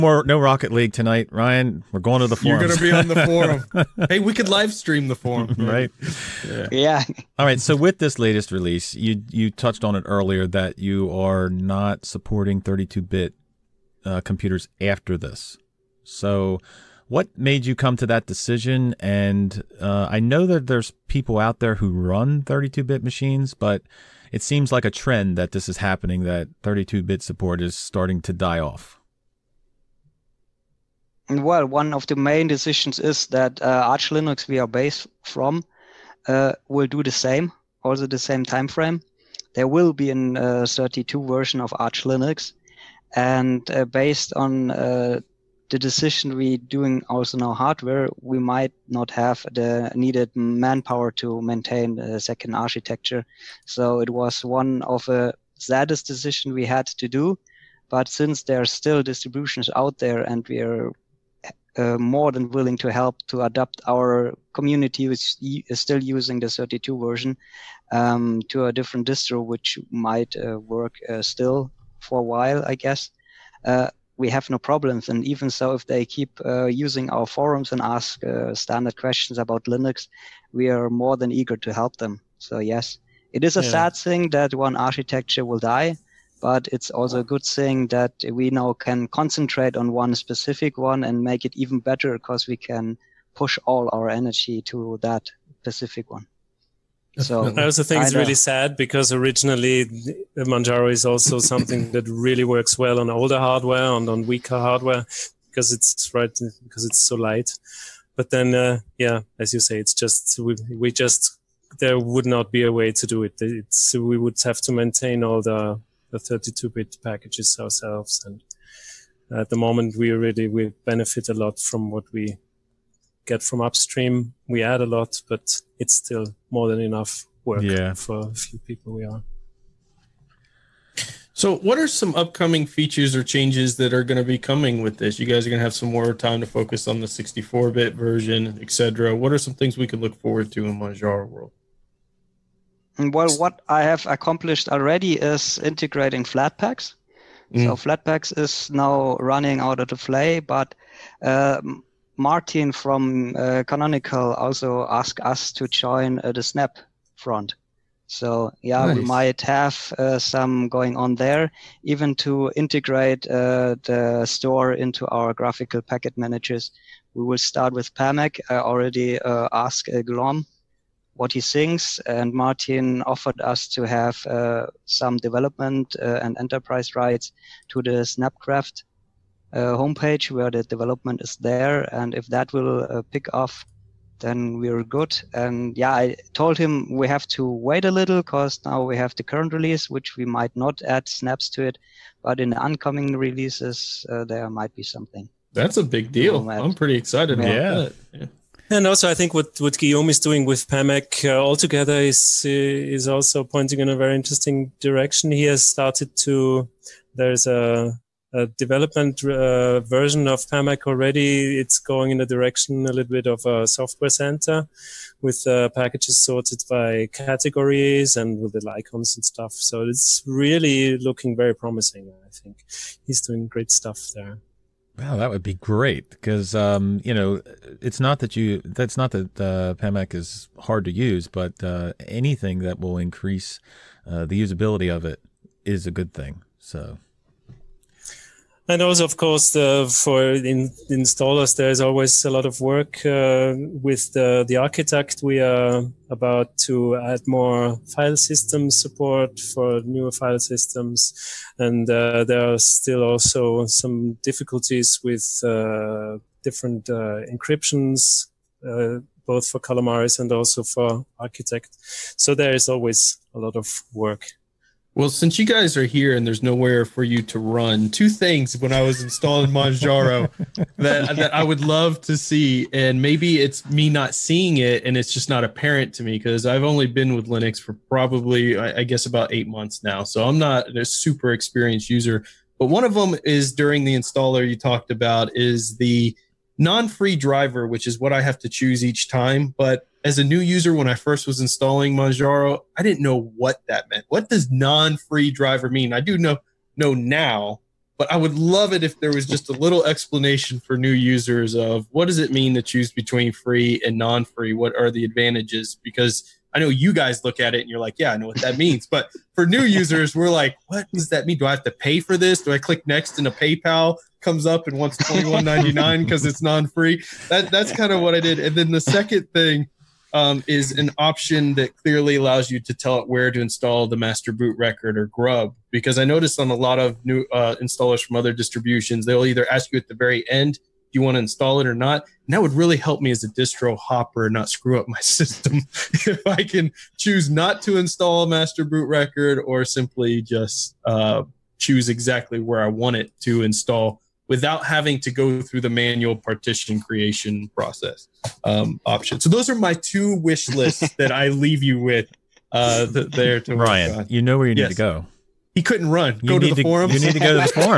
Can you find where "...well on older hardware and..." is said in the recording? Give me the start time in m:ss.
1:42.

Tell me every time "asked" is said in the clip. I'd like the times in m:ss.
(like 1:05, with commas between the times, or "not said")
2:34, 2:49.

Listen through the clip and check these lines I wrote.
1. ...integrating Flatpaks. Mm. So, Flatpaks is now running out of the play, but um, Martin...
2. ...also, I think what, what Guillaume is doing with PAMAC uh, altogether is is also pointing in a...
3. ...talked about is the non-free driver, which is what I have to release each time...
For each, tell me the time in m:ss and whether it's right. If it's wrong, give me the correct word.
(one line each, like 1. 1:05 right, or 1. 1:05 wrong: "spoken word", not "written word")
1. 2:25 right
2. 3:18 right
3. 4:44 wrong: "choose", not "release".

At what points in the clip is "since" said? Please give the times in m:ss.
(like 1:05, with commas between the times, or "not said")
0:58, 4:25.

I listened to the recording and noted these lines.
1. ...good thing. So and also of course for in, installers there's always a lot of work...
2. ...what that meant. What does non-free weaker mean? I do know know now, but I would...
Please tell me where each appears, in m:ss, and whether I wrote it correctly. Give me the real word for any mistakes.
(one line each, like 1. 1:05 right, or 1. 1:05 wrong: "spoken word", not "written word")
1. 3:55 right
2. 4:53 wrong: "driver", not "weaker".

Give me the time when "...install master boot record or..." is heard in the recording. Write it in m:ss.
5:37.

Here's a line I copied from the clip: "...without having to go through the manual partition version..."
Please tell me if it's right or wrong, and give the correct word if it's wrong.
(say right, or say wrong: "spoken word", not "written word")
wrong: "creation", not "version".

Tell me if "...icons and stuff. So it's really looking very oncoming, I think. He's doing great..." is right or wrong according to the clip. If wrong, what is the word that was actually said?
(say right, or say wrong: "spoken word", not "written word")
wrong: "promising", not "oncoming".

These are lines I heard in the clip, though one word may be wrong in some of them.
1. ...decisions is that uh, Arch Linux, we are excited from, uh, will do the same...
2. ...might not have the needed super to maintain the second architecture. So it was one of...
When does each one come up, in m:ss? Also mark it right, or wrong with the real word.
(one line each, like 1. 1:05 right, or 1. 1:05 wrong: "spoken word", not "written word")
1. 0:32 wrong: "based", not "excited"
2. 0:48 wrong: "manpower", not "super".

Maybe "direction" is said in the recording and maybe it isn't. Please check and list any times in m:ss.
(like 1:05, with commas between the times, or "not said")
3:24, 3:32.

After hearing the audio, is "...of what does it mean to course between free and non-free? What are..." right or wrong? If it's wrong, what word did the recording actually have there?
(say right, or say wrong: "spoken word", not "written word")
wrong: "choose", not "course".